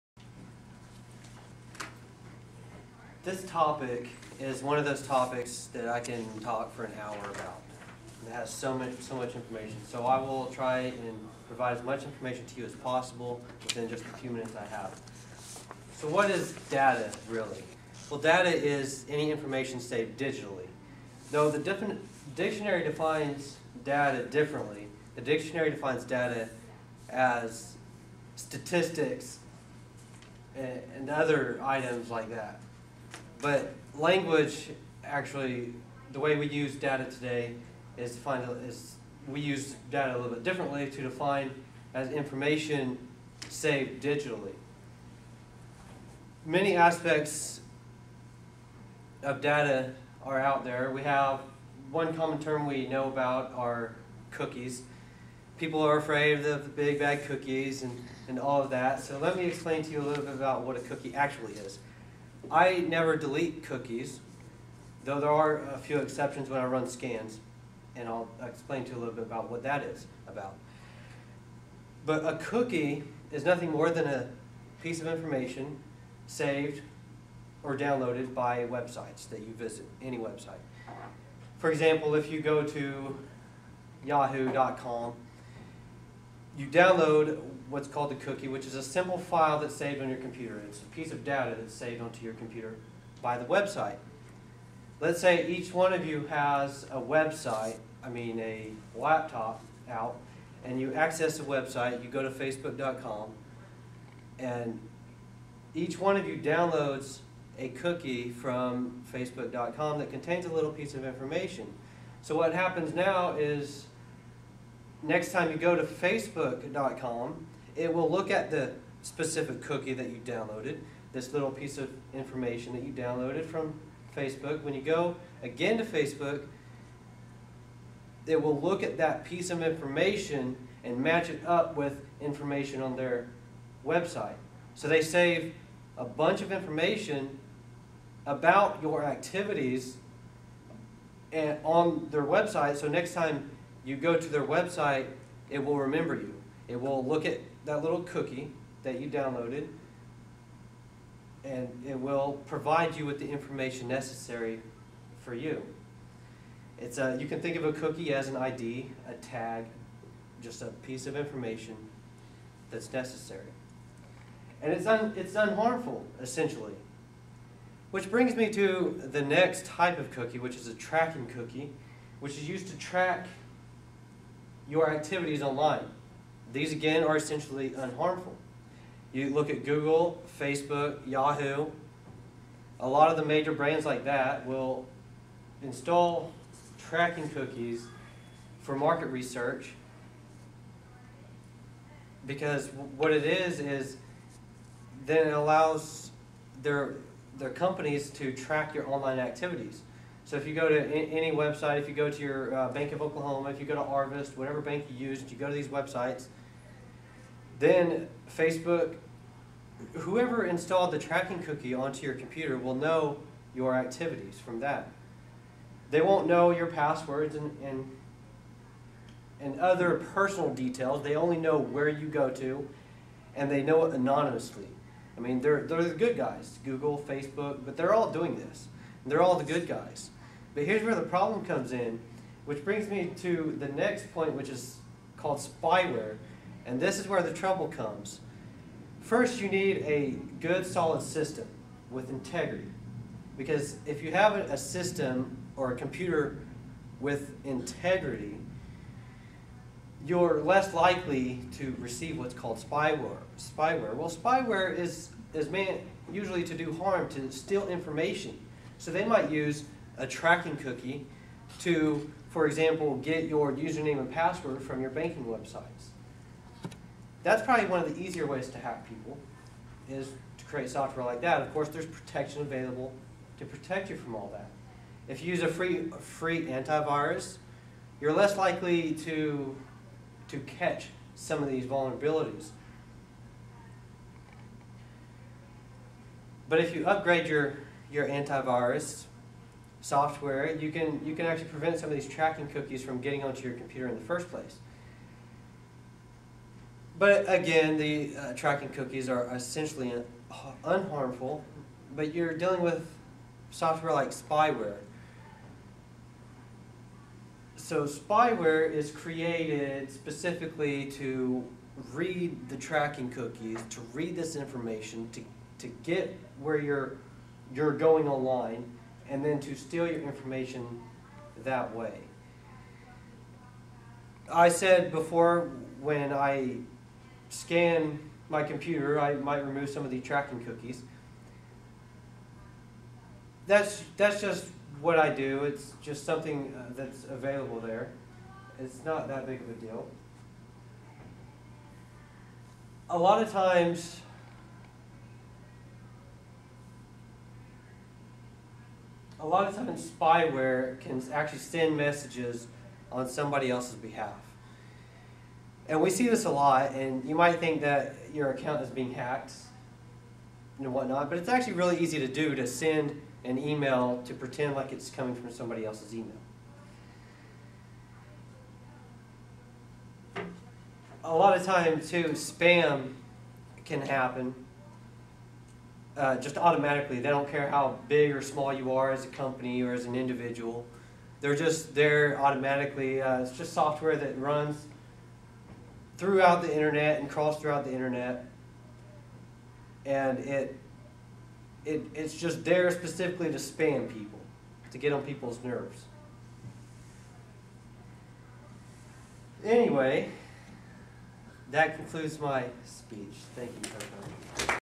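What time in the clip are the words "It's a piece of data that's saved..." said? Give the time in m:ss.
1:30.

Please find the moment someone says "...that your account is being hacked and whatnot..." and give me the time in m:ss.
5:57.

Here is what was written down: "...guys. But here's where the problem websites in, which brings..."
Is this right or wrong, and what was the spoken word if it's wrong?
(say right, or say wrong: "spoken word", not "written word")
wrong: "comes", not "websites".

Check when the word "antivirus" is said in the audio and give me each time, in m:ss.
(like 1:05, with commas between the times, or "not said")
4:36, 4:48.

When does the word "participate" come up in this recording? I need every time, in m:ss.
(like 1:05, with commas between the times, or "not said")
not said.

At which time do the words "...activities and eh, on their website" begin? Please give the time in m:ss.
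2:19.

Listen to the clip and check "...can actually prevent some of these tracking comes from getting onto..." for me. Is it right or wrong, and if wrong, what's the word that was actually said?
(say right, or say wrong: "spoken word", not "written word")
wrong: "cookies", not "comes".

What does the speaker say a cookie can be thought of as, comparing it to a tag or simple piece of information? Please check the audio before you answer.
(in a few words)
an ID.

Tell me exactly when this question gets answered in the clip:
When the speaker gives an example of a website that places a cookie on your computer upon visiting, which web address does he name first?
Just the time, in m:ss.
1:24.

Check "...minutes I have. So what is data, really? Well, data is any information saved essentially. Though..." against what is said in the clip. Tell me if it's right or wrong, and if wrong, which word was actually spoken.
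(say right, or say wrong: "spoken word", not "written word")
wrong: "digitally", not "essentially".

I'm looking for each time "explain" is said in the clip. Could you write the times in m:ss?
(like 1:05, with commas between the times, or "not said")
0:59, 1:08.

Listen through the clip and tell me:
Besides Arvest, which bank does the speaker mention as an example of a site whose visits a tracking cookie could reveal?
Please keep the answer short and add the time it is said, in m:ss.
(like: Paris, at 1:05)
Bank of Oklahoma, at 3:22.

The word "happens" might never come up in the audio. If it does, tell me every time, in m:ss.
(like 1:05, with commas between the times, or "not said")
1:52, 6:13.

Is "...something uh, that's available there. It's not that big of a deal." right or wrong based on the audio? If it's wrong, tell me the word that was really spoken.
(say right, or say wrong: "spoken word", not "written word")
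right.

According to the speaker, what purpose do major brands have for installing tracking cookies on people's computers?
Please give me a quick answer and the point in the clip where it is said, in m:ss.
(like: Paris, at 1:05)
market research, at 3:08.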